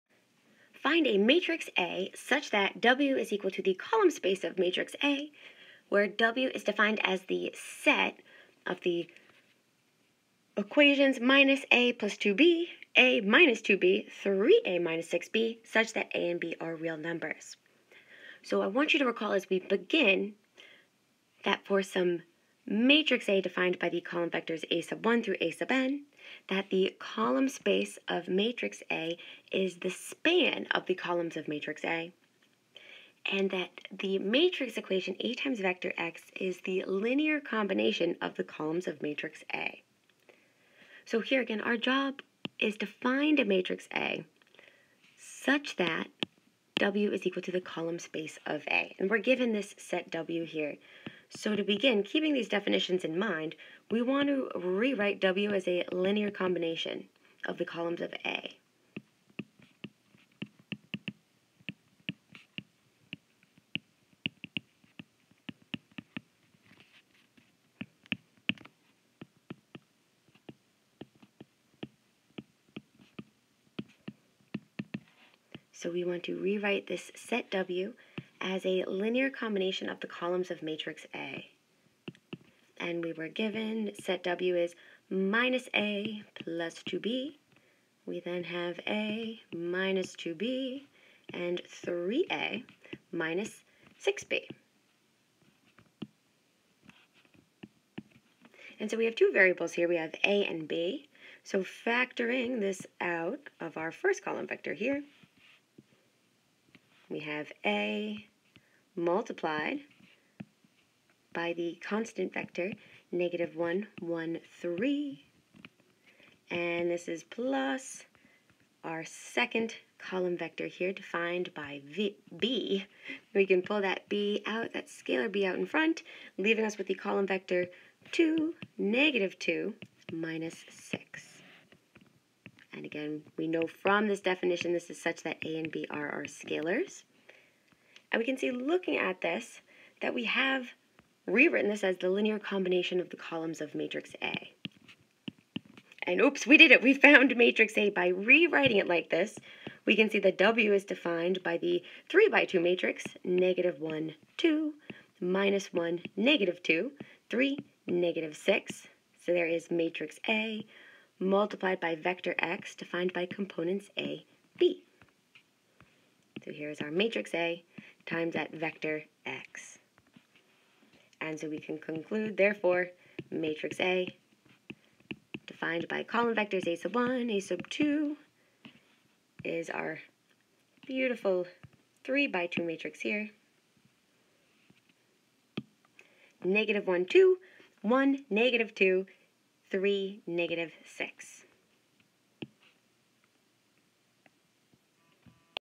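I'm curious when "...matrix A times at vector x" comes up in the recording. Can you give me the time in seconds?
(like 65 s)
166 s.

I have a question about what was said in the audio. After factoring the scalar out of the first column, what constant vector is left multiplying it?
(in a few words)
(-1, 1, 3).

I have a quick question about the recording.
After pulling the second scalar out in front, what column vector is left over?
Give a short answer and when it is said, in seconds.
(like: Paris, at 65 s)
(2, -2, -6), at 128 s.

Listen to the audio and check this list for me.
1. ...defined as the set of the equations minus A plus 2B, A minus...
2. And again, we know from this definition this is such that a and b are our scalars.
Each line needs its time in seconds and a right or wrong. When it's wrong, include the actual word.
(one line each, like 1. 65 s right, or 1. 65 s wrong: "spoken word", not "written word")
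1. 6 s right
2. 132 s right.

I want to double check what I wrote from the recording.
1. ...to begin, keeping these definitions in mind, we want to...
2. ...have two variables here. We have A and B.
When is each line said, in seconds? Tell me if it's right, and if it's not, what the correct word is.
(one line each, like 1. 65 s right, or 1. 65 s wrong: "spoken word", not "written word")
1. 51 s right
2. 99 s right.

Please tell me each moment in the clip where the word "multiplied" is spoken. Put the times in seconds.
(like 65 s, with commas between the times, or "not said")
108 s, 161 s.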